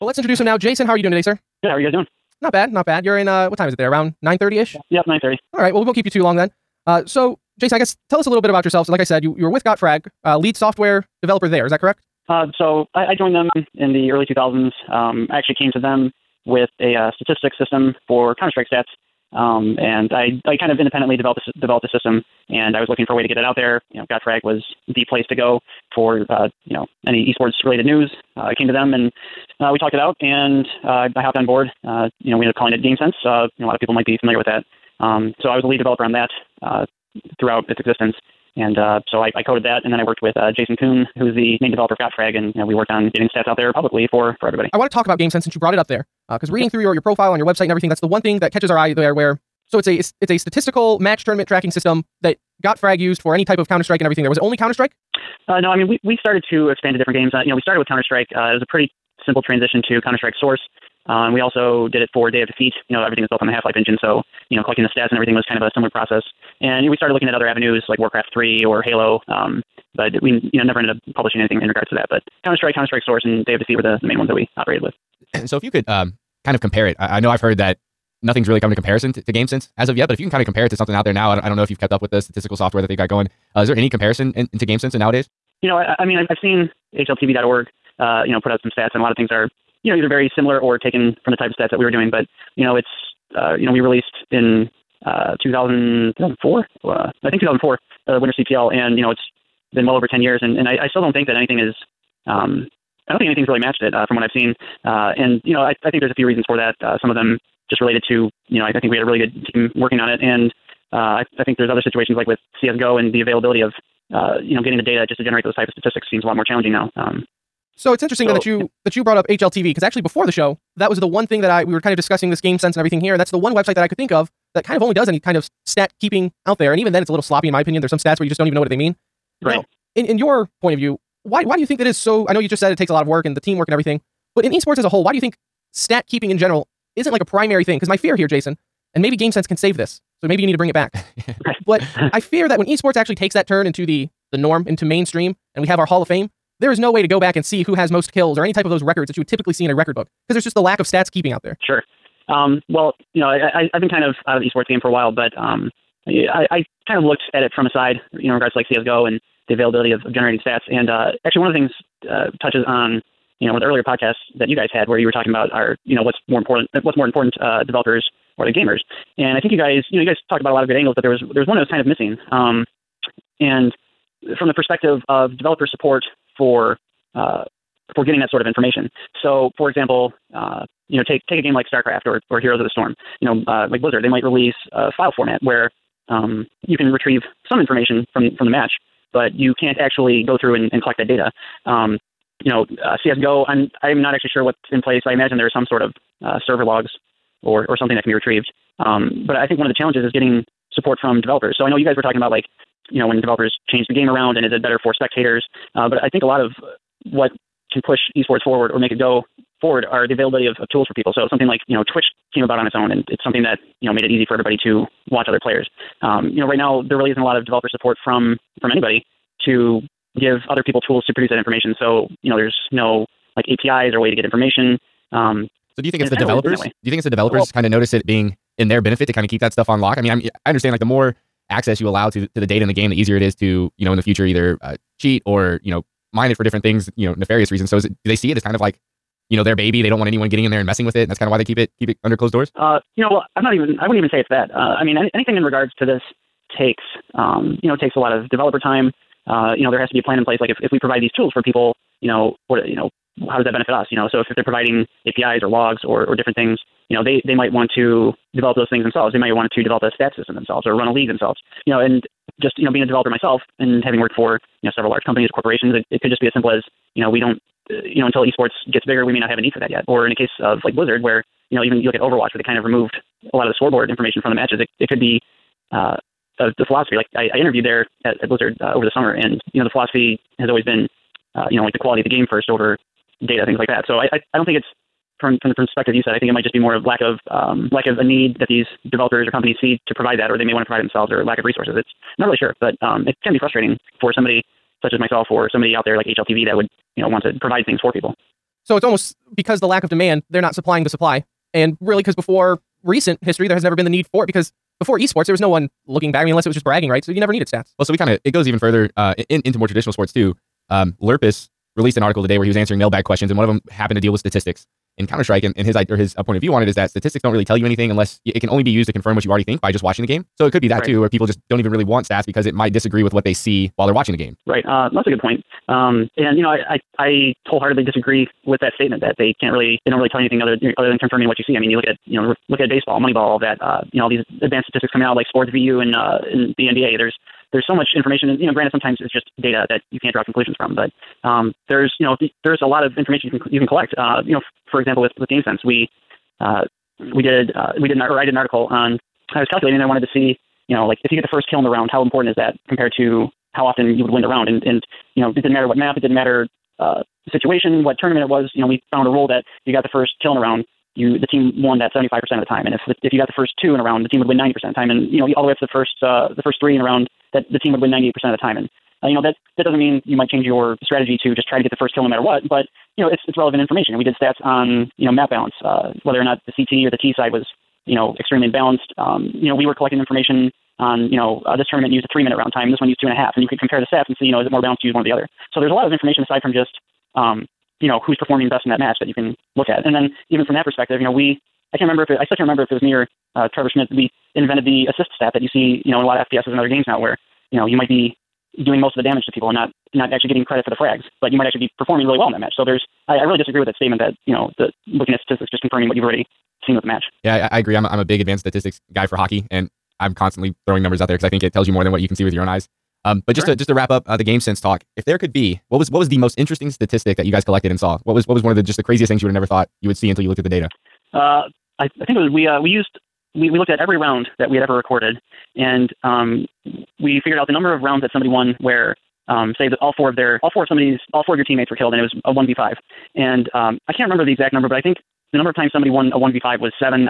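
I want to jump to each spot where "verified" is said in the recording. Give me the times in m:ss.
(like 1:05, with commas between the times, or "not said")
not said.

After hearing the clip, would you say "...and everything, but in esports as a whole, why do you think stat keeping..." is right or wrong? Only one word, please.
right.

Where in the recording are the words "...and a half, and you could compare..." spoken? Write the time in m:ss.
6:23.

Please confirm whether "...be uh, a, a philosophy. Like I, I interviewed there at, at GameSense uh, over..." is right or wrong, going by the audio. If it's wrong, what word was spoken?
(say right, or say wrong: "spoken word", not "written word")
wrong: "Blizzard", not "GameSense".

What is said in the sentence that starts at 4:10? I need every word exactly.
Like if if we provide these tools for people, you know, what you know, how does that benefit us?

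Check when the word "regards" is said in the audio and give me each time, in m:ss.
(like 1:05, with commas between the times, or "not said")
1:11, 2:38, 4:05.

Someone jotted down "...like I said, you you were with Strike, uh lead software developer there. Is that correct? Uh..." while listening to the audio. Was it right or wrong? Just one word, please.
wrong.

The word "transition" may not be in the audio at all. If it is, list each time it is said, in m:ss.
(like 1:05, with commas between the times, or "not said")
0:59.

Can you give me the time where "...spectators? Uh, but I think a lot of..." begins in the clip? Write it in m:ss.
3:24.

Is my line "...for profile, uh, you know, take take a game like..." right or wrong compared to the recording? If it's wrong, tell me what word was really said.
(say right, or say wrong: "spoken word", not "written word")
wrong: "example", not "profile".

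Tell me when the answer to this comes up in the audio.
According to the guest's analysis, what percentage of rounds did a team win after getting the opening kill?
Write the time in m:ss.
6:01.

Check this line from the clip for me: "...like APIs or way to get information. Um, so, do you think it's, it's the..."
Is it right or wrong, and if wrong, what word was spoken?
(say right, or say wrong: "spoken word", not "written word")
right.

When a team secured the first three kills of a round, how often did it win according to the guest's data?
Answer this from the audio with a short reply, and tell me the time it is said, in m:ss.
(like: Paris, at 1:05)
98%, at 6:07.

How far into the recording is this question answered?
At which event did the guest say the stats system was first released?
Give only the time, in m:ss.
1:38.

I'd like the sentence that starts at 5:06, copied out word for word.
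I mean, unless it was just bragging rights, so you never needed stats.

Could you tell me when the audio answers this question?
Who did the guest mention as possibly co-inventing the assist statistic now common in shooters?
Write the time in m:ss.
6:33.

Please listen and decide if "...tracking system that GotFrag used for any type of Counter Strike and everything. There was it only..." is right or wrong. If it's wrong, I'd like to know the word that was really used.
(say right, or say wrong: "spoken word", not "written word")
right.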